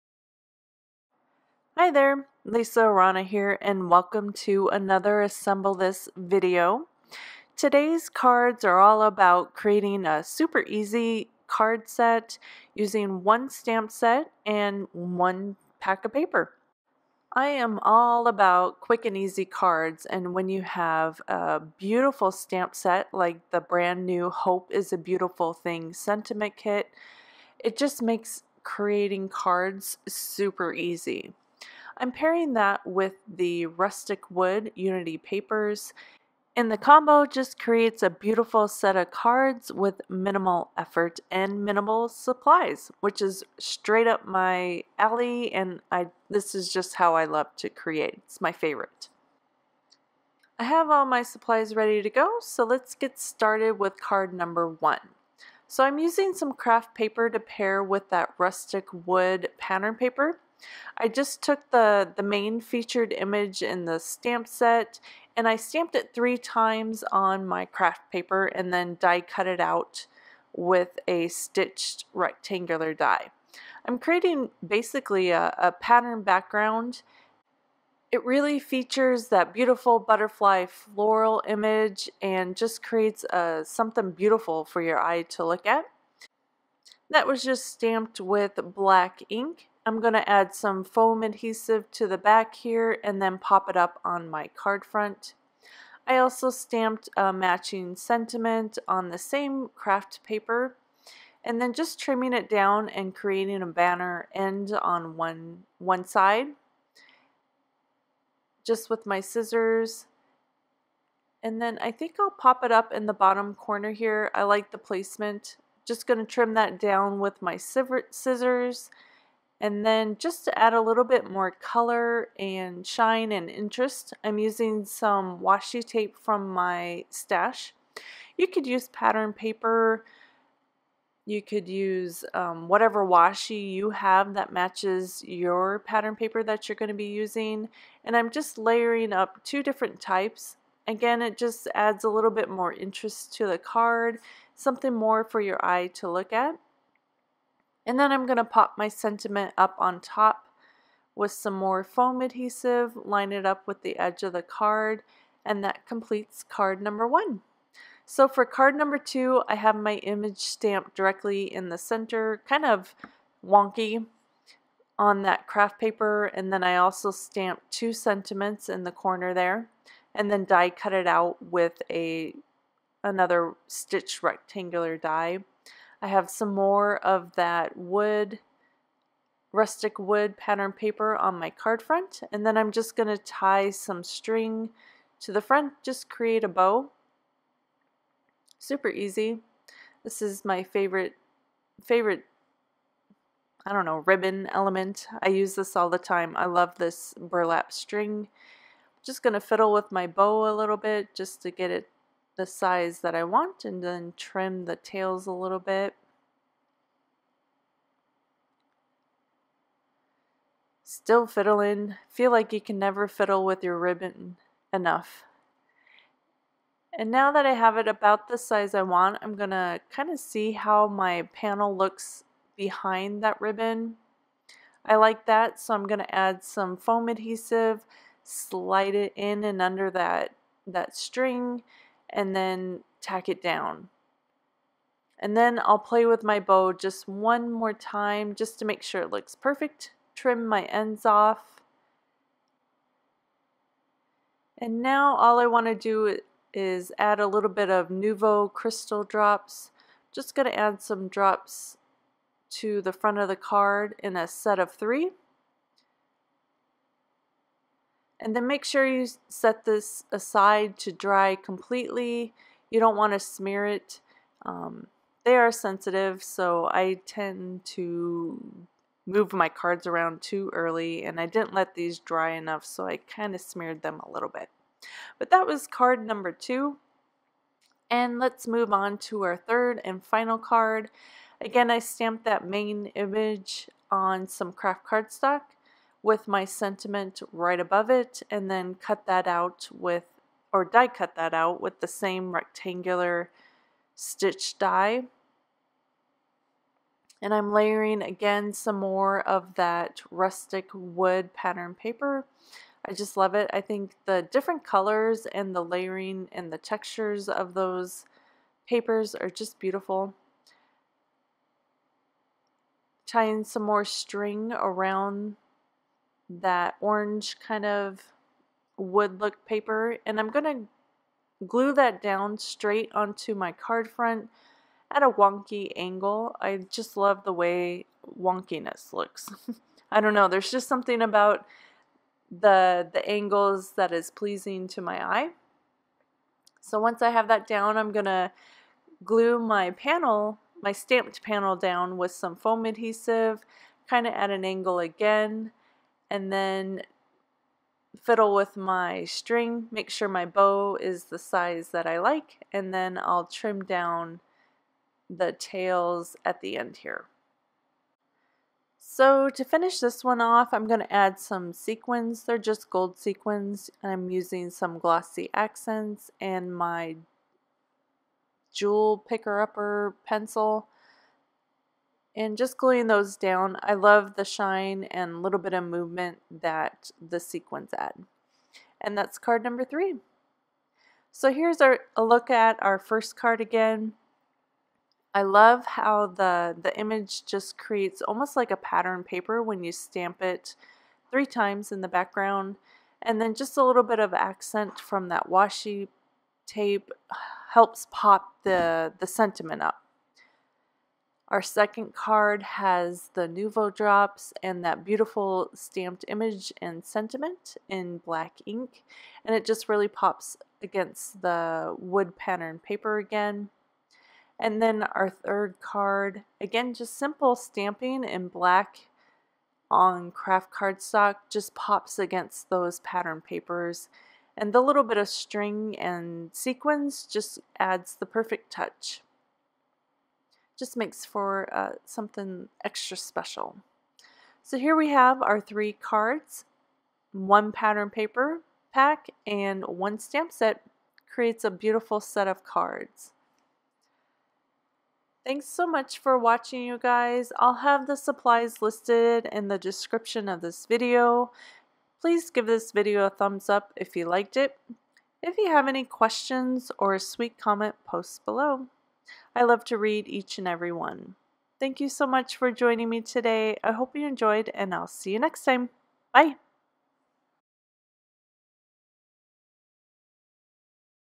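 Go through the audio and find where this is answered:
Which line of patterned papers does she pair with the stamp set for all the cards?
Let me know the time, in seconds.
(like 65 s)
33 s.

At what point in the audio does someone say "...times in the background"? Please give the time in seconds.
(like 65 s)
391 s.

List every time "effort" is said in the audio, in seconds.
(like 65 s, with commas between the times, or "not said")
40 s.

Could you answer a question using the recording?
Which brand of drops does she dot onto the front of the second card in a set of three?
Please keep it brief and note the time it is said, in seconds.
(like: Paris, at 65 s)
Nuvo crystal drops, at 247 s.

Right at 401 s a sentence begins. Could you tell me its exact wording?
Our second card has the Nuvo drops and that beautiful stamped image and sentiment in black ink.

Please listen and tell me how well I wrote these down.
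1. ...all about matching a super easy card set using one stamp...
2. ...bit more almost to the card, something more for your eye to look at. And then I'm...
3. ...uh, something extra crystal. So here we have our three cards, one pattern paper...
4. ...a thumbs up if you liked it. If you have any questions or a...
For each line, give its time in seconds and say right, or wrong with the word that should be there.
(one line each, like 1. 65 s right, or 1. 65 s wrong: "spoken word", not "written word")
1. 8 s wrong: "creating", not "matching"
2. 142 s wrong: "interest", not "almost"
3. 431 s wrong: "special", not "crystal"
4. 453 s right.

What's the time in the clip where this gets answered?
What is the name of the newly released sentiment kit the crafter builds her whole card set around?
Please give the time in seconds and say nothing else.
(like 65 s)
24 s.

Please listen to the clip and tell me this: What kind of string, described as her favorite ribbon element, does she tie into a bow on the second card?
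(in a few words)
burlap string.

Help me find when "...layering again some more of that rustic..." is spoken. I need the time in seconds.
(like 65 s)
297 s.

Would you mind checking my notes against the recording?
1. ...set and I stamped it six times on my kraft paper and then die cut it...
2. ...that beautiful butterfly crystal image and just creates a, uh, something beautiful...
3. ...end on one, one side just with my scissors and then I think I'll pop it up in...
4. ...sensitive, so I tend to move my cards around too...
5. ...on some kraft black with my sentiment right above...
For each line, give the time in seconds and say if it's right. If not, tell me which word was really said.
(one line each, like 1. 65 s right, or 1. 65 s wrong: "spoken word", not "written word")
1. 64 s wrong: "three", not "six"
2. 79 s wrong: "floral", not "crystal"
3. 104 s right
4. 265 s right
5. 283 s wrong: "cardstock", not "black".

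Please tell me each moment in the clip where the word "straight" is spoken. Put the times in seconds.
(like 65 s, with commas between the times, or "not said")
43 s, 322 s.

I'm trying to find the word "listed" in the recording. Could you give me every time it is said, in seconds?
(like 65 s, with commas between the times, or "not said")
448 s.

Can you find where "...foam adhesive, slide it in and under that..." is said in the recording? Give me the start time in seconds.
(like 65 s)
226 s.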